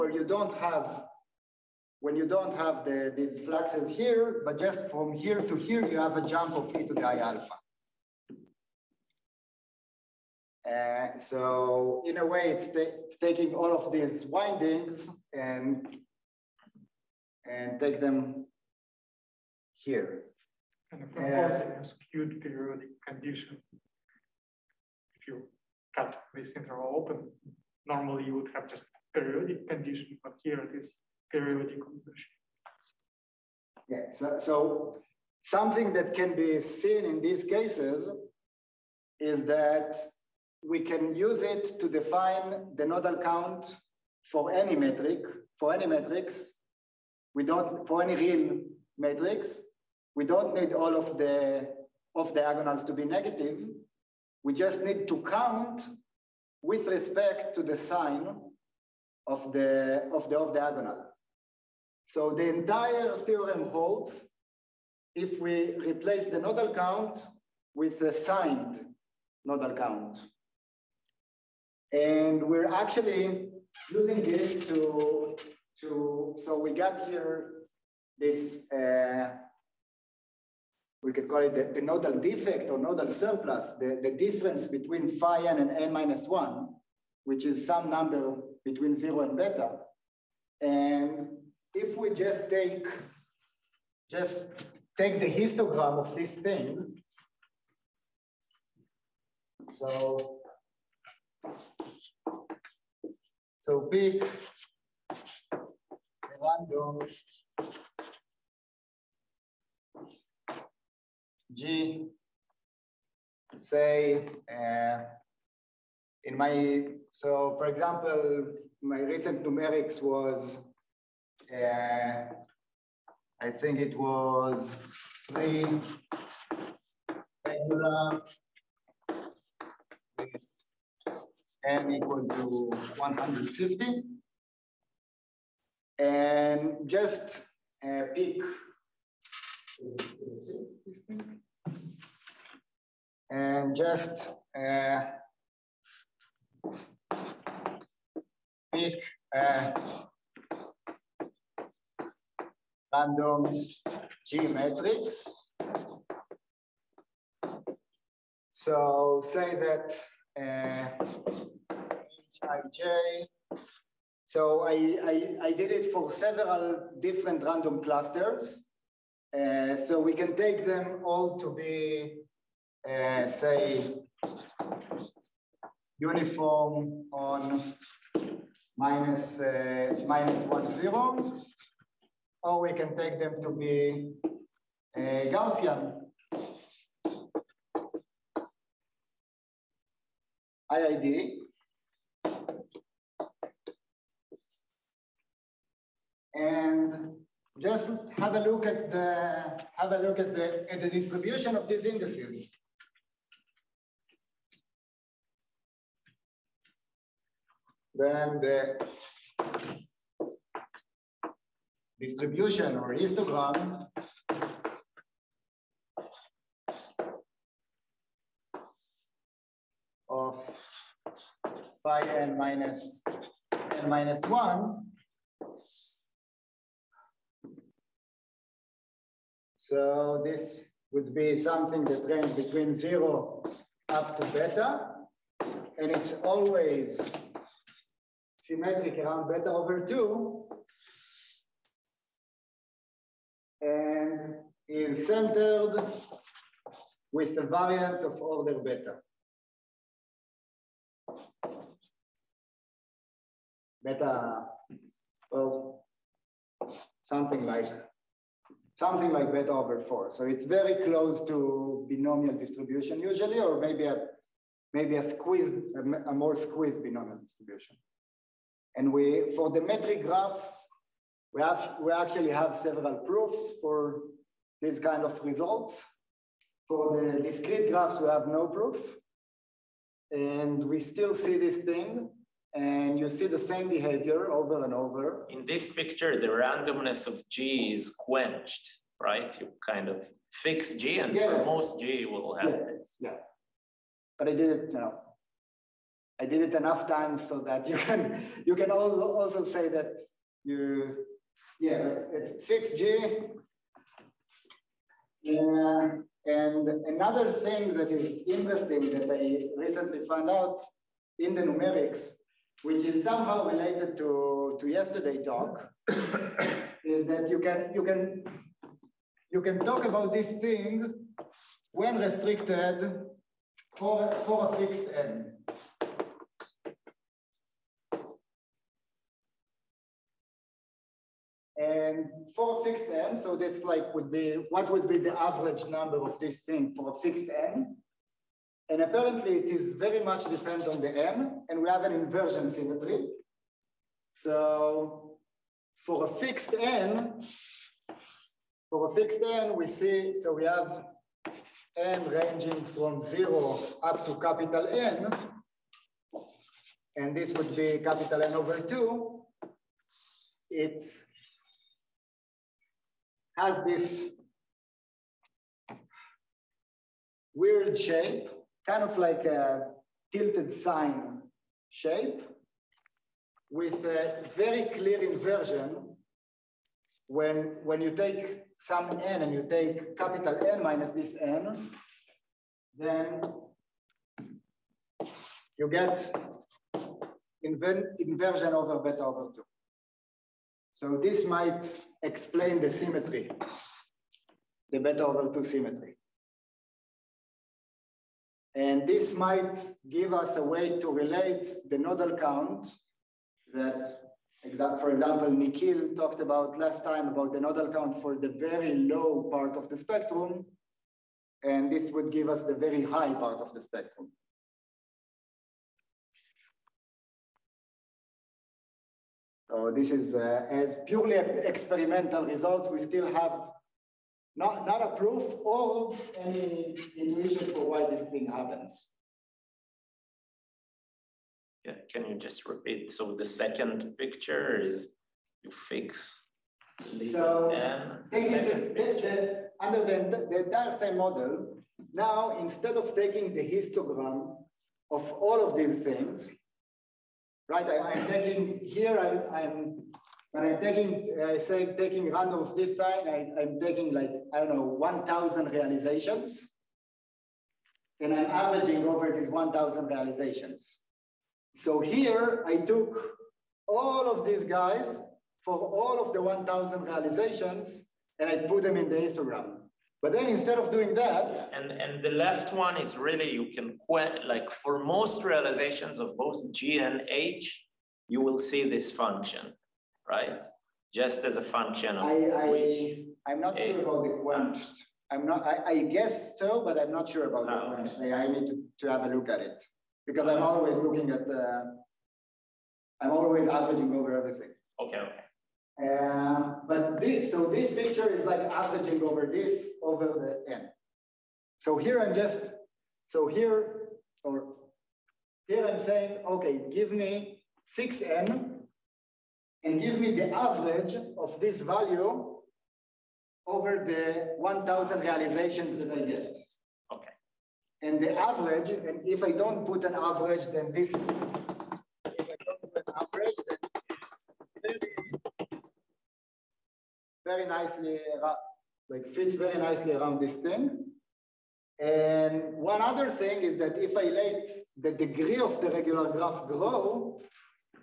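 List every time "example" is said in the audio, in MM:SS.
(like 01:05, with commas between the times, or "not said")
01:57, 06:44.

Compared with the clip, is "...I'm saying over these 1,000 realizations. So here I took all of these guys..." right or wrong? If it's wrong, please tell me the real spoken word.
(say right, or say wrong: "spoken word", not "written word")
wrong: "averaging", not "saying".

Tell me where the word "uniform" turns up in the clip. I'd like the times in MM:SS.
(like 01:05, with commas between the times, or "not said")
02:55.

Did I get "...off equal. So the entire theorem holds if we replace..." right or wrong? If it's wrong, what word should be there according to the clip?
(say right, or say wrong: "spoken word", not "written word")
wrong: "diagonal", not "equal".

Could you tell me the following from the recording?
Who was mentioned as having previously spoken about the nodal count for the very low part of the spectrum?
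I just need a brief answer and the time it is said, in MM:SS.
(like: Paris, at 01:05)
Nikhil, at 06:45.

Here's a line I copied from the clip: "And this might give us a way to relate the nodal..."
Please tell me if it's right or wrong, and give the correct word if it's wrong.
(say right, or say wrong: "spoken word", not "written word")
right.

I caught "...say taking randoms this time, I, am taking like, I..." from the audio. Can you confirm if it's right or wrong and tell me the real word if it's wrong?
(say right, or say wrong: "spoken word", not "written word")
right.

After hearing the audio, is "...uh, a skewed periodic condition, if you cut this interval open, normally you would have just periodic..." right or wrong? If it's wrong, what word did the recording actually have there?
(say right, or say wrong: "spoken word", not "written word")
right.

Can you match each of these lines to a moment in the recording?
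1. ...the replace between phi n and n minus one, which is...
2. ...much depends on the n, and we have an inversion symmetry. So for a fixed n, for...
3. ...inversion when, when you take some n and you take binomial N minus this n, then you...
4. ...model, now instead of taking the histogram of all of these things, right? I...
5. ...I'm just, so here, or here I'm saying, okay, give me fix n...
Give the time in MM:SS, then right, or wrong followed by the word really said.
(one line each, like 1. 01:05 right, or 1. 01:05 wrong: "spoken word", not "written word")
1. 01:24 wrong: "difference", not "replace"
2. 05:40 right
3. 06:15 wrong: "capital", not "binomial"
4. 07:20 right
5. 08:22 right.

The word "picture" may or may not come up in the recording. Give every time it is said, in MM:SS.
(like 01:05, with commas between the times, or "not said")
04:45, 07:13, 08:17.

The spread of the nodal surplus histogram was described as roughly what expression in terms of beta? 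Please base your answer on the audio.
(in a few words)
beta over 4.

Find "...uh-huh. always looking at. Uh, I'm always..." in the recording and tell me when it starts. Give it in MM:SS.
08:10.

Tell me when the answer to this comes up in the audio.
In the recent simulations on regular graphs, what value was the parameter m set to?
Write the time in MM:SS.
02:11.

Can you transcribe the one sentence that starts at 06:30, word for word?
So this might explain the symmetry, the beta over 2 symmetry.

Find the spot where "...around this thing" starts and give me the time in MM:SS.
08:49.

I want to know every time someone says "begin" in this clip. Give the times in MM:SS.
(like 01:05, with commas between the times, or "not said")
not said.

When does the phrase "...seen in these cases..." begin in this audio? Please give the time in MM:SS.
00:36.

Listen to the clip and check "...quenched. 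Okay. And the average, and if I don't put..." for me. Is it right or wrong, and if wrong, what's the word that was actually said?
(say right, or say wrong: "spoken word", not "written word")
wrong: "guessed", not "quenched".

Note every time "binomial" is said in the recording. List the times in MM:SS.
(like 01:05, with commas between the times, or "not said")
04:21, 04:26.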